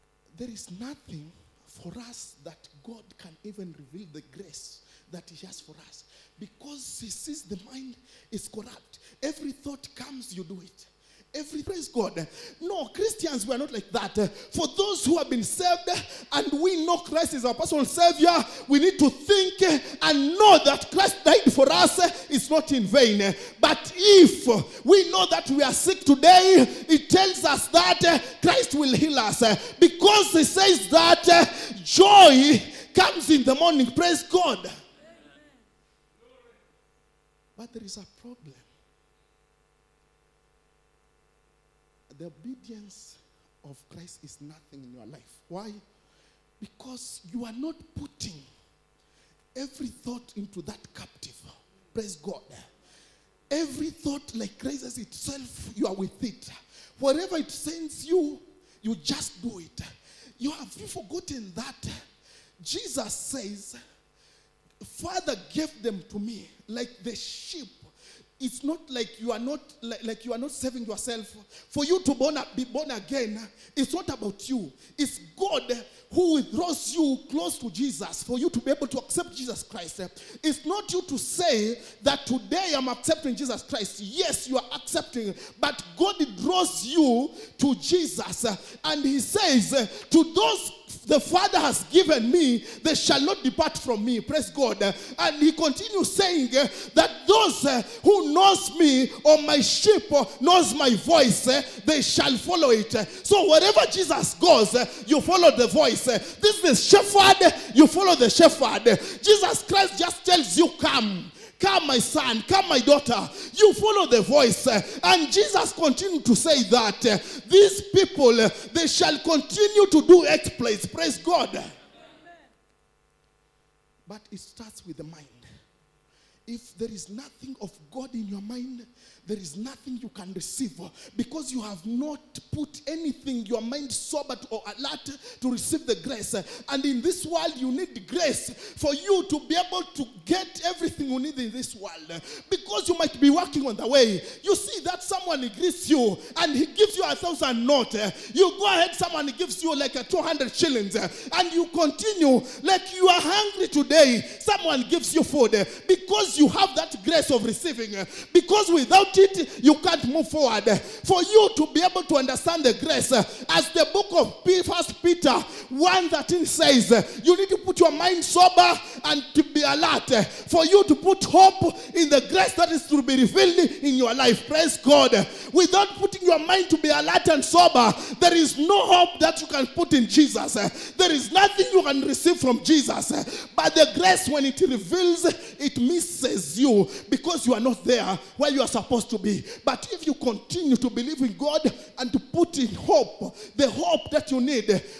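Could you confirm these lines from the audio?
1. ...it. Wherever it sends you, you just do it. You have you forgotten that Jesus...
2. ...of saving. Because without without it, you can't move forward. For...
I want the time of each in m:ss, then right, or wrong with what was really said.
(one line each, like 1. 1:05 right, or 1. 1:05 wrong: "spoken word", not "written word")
1. 0:56 right
2. 2:37 wrong: "receiving", not "saving".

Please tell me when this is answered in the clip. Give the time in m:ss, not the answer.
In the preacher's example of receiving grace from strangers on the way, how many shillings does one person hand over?
2:30.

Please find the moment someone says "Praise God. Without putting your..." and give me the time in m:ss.
2:54.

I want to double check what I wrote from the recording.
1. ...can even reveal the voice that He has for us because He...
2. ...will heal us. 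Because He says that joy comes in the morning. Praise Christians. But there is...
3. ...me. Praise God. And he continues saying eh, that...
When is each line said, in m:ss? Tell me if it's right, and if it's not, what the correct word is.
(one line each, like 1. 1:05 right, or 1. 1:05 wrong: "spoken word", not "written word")
1. 0:03 wrong: "grace", not "voice"
2. 0:28 wrong: "God", not "Christians"
3. 1:34 right.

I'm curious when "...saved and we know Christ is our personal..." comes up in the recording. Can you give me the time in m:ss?
0:15.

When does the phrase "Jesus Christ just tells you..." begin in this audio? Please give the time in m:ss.
1:49.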